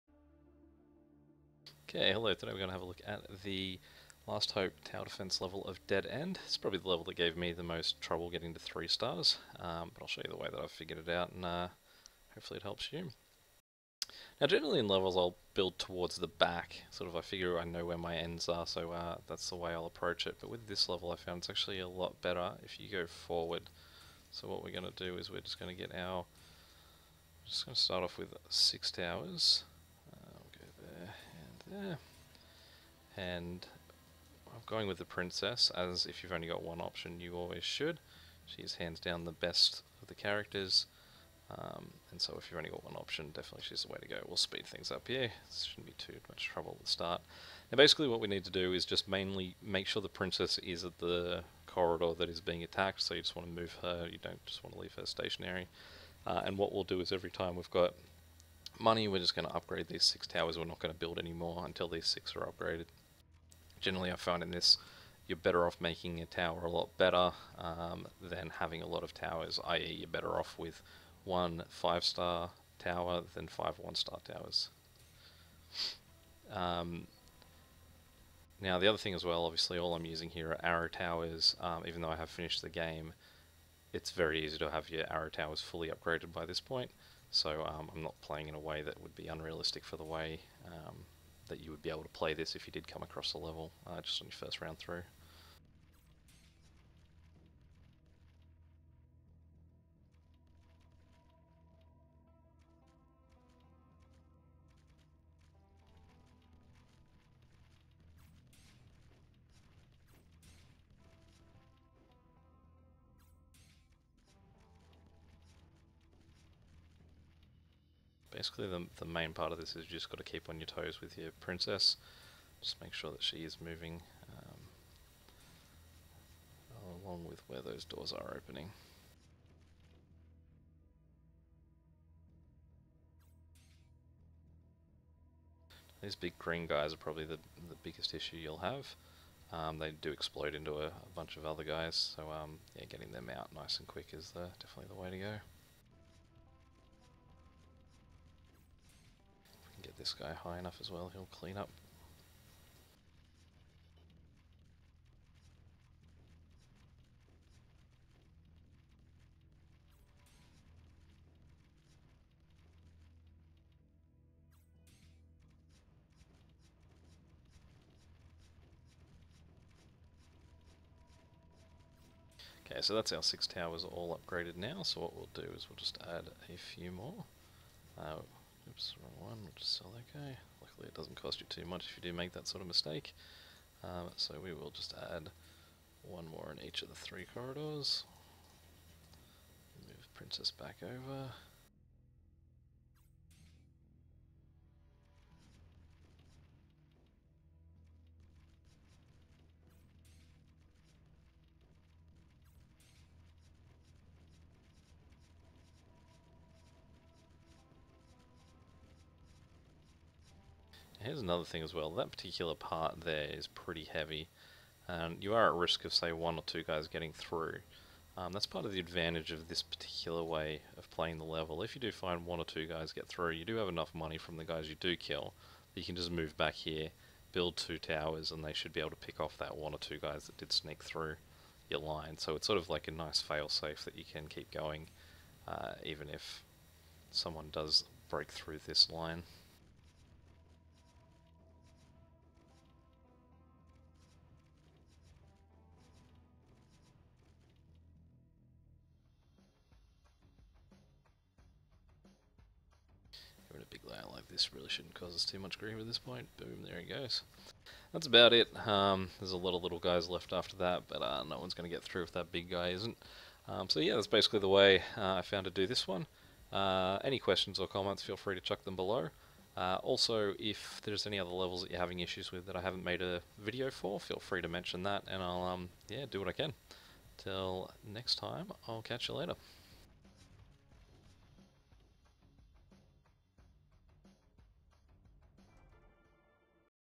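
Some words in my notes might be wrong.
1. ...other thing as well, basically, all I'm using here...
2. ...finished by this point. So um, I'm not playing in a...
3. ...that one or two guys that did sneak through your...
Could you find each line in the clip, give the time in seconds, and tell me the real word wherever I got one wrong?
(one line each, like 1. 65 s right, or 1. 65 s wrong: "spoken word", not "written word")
1. 78 s wrong: "obviously", not "basically"
2. 85 s wrong: "upgraded", not "finished"
3. 229 s right.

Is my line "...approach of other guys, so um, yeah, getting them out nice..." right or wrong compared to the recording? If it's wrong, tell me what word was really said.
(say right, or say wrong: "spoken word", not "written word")
wrong: "bunch", not "approach".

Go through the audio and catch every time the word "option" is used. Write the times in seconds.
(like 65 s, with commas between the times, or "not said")
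36 s, 42 s.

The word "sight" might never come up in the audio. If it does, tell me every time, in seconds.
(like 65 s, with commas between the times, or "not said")
not said.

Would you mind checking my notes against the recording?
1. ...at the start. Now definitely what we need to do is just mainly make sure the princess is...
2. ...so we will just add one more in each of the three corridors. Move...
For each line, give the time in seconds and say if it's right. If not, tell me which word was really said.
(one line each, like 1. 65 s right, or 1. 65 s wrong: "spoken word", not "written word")
1. 46 s wrong: "basically", not "definitely"
2. 184 s right.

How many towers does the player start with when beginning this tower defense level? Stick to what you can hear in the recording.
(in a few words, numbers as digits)
6.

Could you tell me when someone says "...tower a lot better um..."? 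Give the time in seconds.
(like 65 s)
66 s.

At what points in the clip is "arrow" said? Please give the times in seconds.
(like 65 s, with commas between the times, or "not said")
80 s, 85 s.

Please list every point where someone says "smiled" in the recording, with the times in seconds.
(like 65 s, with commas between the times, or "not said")
not said.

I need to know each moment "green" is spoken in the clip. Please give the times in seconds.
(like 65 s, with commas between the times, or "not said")
136 s.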